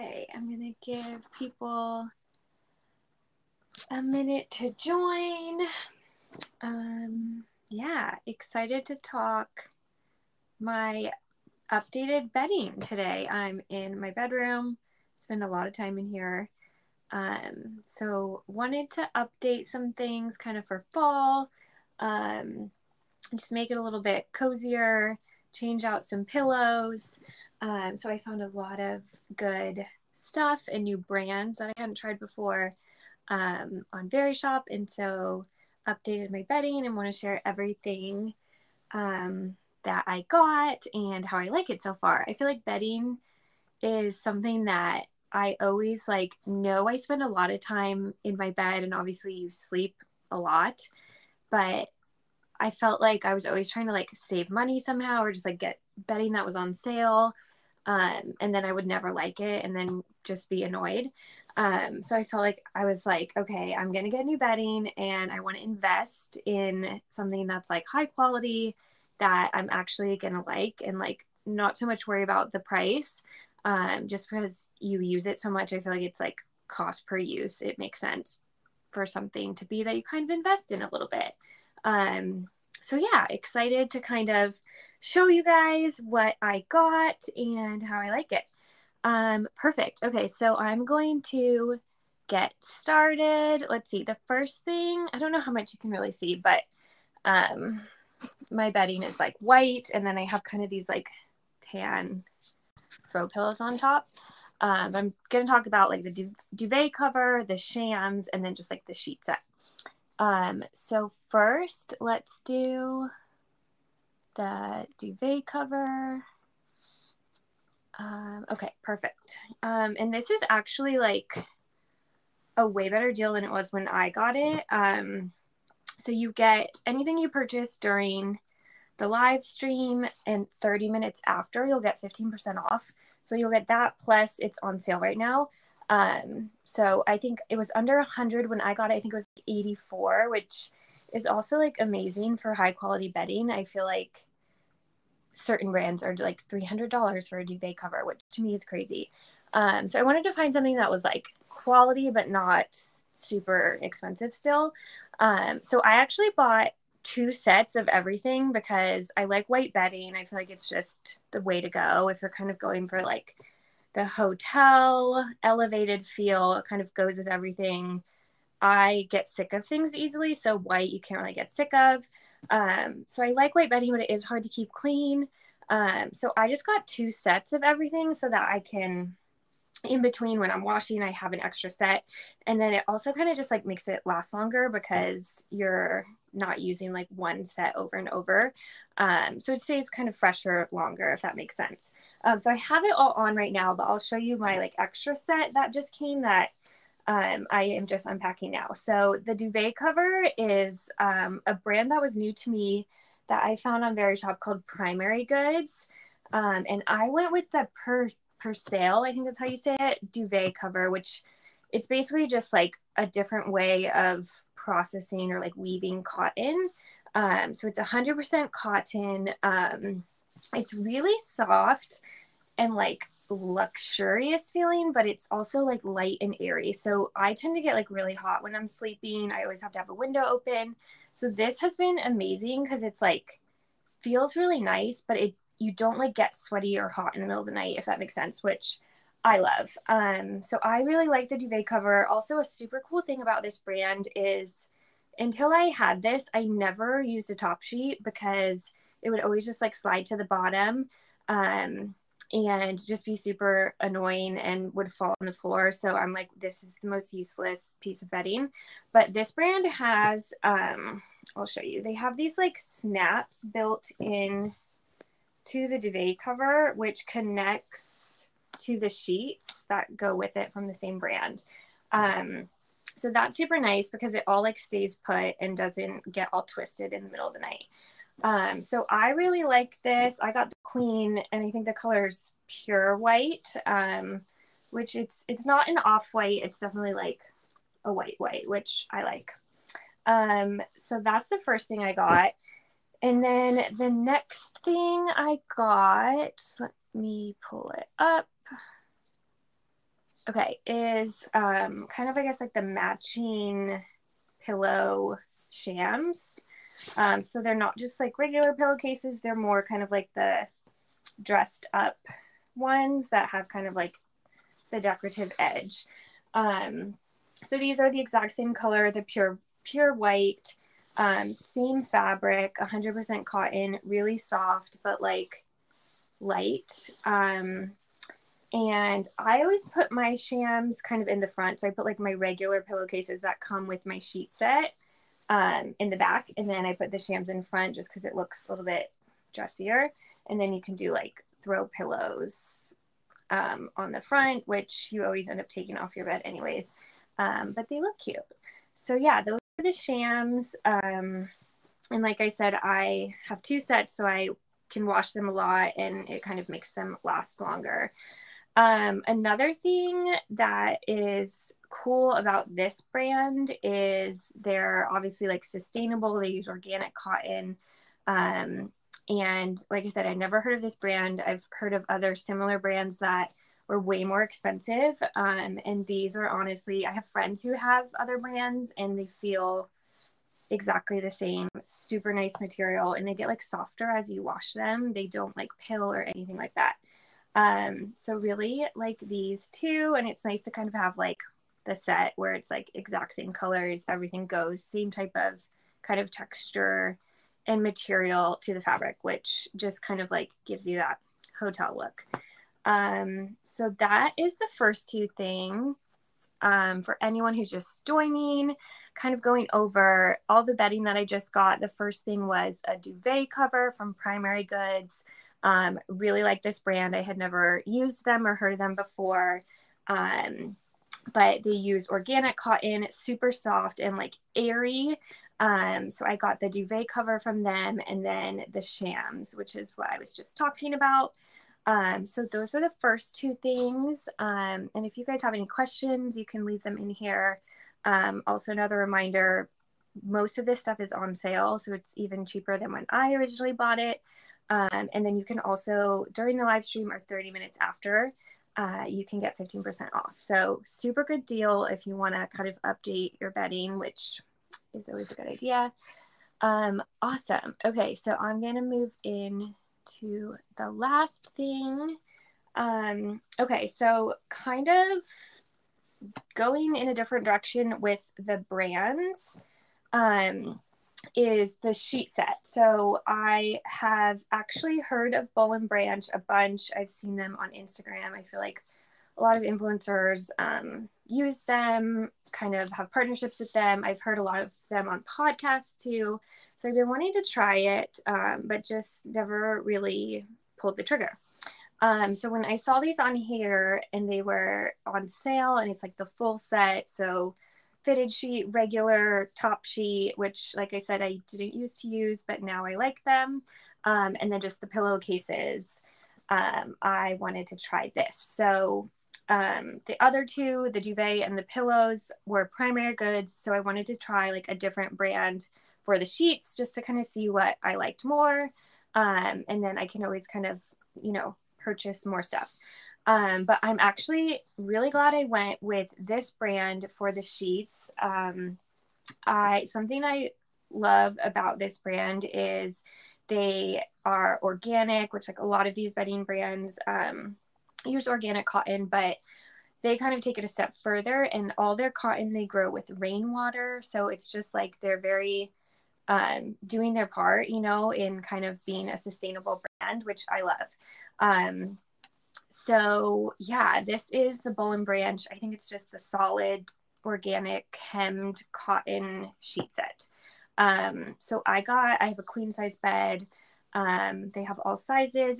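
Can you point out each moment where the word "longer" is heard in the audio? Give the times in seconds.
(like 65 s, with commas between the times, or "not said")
184 s, 190 s, 357 s.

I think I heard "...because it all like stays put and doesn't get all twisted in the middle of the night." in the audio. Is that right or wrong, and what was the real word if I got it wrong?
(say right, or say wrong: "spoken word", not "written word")
right.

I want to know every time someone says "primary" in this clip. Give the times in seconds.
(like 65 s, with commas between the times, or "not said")
204 s, 413 s, 512 s.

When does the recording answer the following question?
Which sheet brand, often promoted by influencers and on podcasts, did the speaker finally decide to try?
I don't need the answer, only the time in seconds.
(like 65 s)
475 s.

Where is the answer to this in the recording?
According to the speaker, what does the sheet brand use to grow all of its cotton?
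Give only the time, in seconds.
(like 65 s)
542 s.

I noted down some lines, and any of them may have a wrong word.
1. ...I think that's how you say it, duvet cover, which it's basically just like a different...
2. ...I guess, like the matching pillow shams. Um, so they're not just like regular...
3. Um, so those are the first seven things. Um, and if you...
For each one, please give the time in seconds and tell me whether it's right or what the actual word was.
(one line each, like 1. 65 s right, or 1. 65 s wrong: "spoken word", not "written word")
1. 209 s right
2. 302 s right
3. 431 s wrong: "two", not "seven".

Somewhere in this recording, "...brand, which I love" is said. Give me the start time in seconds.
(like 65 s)
549 s.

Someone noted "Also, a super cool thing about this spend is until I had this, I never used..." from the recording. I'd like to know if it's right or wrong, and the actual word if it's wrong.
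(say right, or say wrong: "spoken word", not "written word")
wrong: "brand", not "spend".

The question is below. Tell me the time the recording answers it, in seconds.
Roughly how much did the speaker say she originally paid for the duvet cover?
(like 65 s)
139 s.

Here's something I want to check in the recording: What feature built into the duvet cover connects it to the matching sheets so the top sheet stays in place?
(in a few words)
snaps.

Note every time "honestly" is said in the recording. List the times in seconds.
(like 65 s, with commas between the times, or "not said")
376 s.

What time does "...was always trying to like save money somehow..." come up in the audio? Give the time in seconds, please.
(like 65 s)
53 s.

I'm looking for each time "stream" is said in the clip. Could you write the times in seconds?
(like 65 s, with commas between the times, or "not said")
129 s, 446 s.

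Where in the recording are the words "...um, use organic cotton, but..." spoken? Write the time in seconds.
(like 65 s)
536 s.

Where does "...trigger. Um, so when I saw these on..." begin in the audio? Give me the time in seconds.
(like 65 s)
490 s.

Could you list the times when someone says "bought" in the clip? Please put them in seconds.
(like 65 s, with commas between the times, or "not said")
156 s, 443 s.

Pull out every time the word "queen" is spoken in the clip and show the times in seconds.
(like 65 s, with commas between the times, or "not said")
280 s, 562 s.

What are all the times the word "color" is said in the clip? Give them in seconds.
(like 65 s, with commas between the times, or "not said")
281 s, 318 s, 393 s.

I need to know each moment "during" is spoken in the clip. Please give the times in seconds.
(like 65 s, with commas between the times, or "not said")
127 s, 446 s.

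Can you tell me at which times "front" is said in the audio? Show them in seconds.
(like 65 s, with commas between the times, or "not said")
331 s, 337 s, 343 s.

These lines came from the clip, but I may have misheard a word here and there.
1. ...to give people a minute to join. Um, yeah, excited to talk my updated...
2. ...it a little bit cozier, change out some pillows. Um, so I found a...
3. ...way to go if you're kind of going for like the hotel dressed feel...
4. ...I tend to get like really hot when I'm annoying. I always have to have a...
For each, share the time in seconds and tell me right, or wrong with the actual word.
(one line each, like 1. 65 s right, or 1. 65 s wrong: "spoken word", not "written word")
1. 0 s right
2. 23 s right
3. 161 s wrong: "elevated", not "dressed"
4. 227 s wrong: "sleeping", not "annoying".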